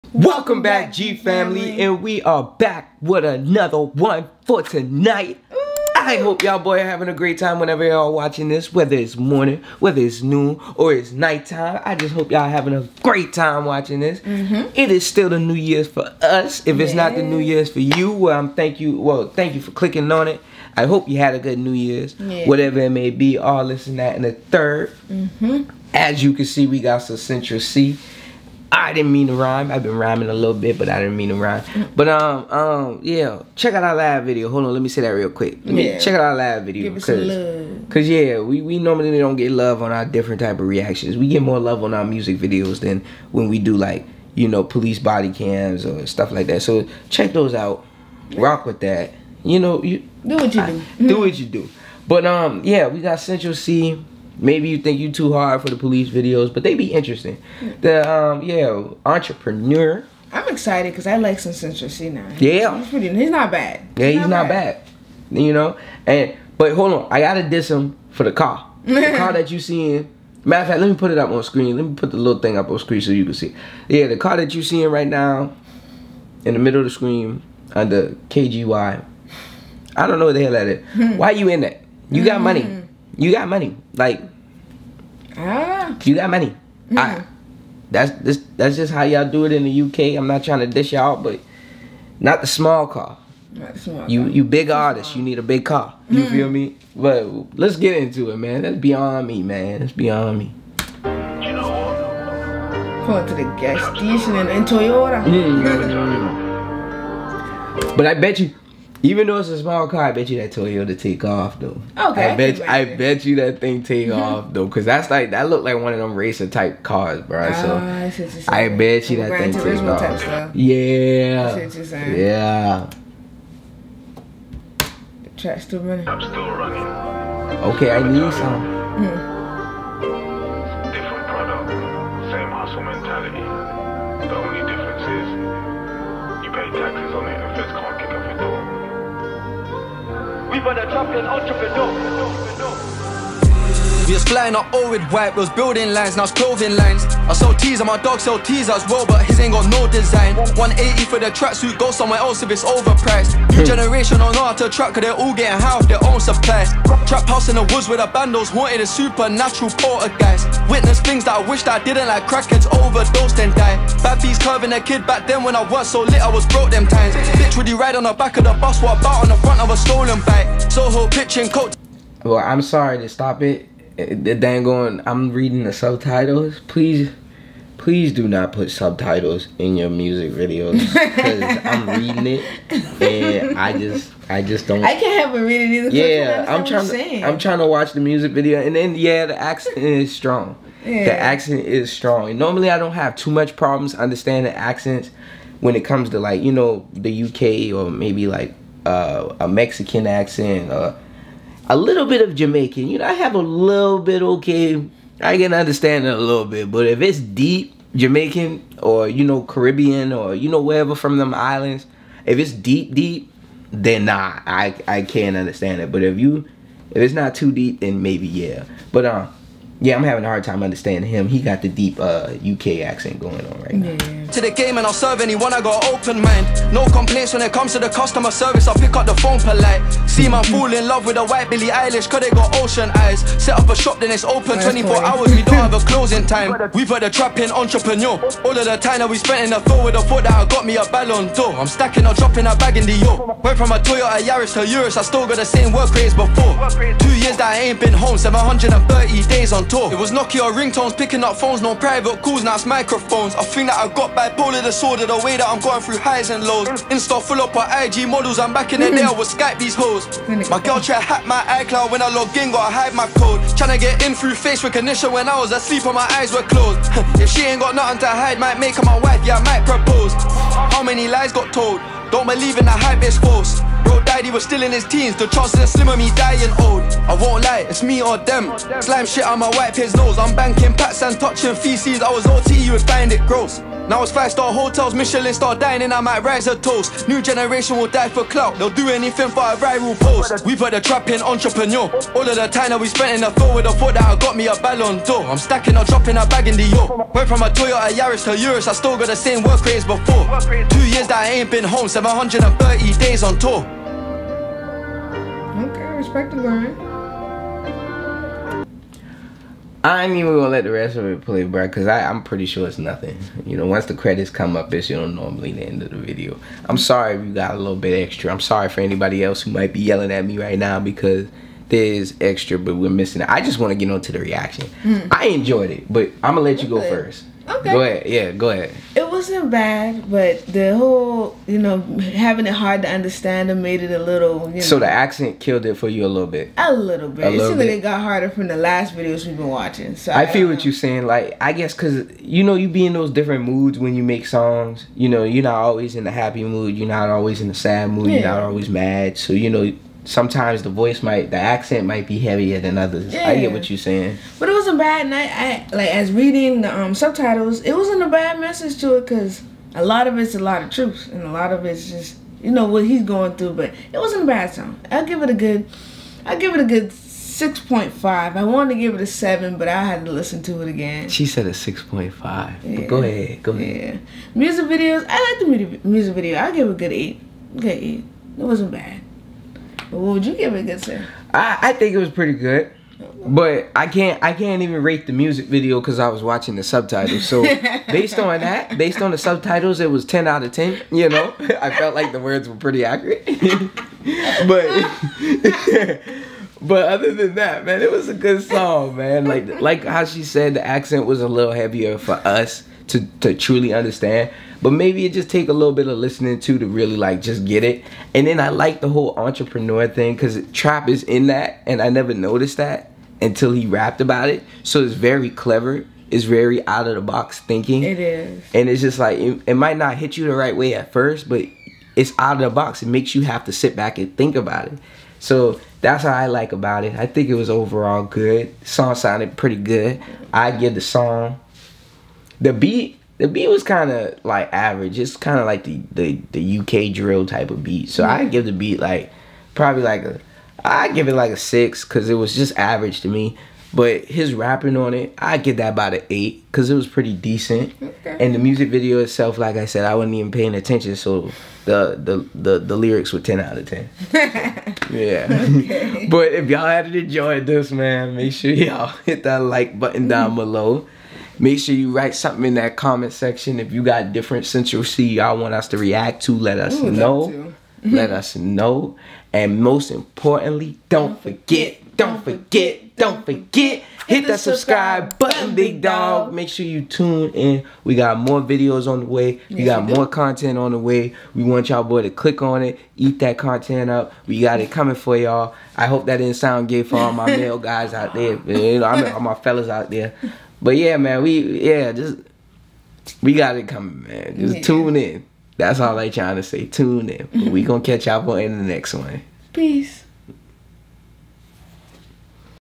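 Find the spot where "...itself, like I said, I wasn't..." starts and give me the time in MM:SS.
07:28.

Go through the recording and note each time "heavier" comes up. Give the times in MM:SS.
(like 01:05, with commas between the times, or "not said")
05:52, 06:41.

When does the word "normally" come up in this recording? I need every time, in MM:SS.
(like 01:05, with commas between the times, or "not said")
00:38, 03:12, 05:15.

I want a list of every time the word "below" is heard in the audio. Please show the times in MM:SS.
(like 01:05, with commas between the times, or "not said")
07:40.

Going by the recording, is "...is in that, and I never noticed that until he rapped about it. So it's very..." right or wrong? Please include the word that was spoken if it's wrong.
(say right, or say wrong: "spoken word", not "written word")
right.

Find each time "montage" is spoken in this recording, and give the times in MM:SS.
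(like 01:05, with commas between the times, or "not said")
not said.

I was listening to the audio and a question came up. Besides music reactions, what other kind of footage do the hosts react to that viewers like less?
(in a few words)
police body cams.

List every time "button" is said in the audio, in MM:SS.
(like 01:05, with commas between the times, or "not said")
07:39, 07:55.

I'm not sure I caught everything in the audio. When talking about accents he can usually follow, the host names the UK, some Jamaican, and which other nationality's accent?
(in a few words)
Mexican.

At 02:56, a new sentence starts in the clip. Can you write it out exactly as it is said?
Please please do not put subtitles in your music videos because I'm reading it and I just I just don't.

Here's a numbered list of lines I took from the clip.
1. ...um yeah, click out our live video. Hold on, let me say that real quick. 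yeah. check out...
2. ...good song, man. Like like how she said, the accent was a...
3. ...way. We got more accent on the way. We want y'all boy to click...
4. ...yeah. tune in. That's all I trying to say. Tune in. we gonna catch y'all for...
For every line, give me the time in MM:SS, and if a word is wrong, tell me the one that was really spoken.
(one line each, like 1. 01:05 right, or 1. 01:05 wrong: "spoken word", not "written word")
1. 00:32 wrong: "check", not "click"
2. 06:38 right
3. 07:59 wrong: "content", not "accent"
4. 08:14 right.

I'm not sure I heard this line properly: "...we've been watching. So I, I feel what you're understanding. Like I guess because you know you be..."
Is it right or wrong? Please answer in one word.
wrong.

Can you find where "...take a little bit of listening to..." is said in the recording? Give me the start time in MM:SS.
06:45.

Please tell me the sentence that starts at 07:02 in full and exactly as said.
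It makes you have to sit back and think about it.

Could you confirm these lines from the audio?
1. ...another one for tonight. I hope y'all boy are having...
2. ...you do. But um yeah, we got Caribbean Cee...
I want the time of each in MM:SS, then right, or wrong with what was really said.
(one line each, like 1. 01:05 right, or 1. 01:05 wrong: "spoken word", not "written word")
1. 00:03 right
2. 00:51 wrong: "Central", not "Caribbean".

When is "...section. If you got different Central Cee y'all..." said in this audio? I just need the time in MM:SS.
07:43.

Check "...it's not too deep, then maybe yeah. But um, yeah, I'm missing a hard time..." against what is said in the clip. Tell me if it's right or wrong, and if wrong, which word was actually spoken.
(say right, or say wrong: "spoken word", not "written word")
wrong: "having", not "missing".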